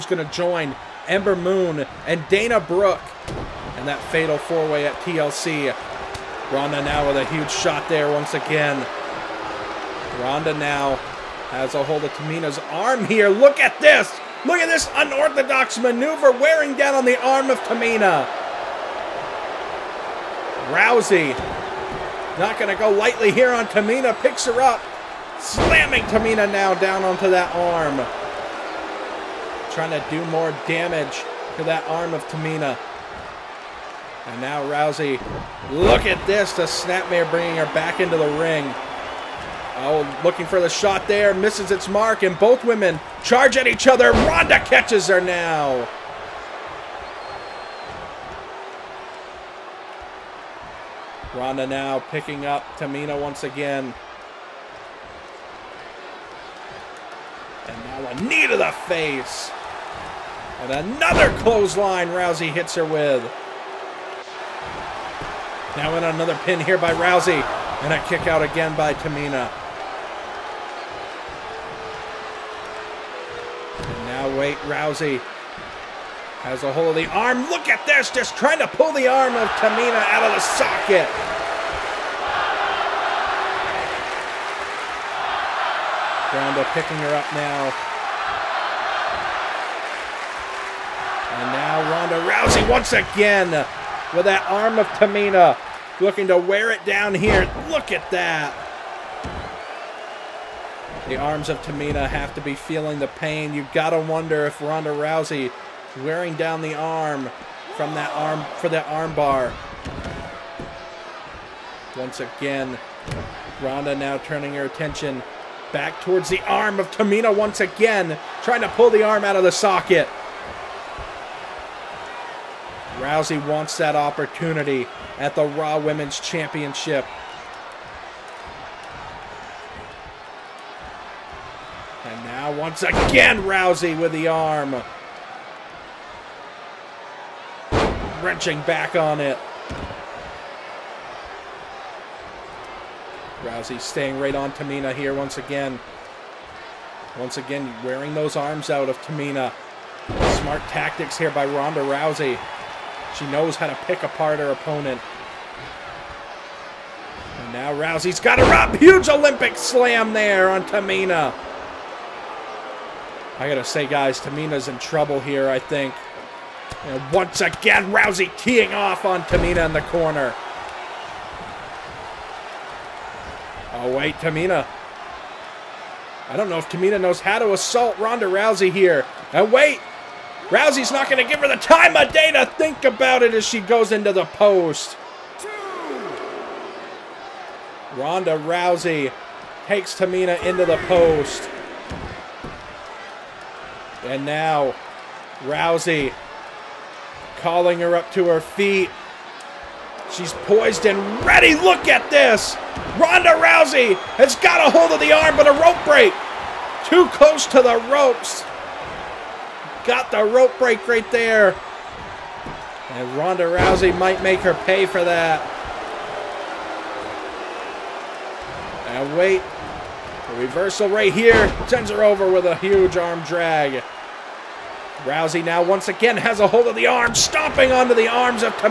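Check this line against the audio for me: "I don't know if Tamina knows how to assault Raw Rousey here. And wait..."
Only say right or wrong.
wrong.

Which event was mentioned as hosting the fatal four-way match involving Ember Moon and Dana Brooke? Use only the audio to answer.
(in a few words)
TLC.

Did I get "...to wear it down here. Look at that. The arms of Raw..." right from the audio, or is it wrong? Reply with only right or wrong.
wrong.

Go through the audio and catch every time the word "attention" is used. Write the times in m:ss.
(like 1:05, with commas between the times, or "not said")
1:54.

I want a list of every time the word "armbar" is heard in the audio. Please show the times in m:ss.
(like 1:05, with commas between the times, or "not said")
1:48.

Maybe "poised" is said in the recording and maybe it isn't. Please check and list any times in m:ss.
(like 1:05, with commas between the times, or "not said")
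3:20.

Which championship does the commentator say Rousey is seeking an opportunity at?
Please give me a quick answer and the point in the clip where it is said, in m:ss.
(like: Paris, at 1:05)
Raw Women's Championship, at 2:05.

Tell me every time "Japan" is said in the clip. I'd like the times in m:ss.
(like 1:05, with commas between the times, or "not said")
not said.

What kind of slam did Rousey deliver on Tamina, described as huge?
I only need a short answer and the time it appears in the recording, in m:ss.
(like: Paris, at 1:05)
Olympic slam, at 2:39.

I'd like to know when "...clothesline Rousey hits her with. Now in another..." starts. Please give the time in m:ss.
1:01.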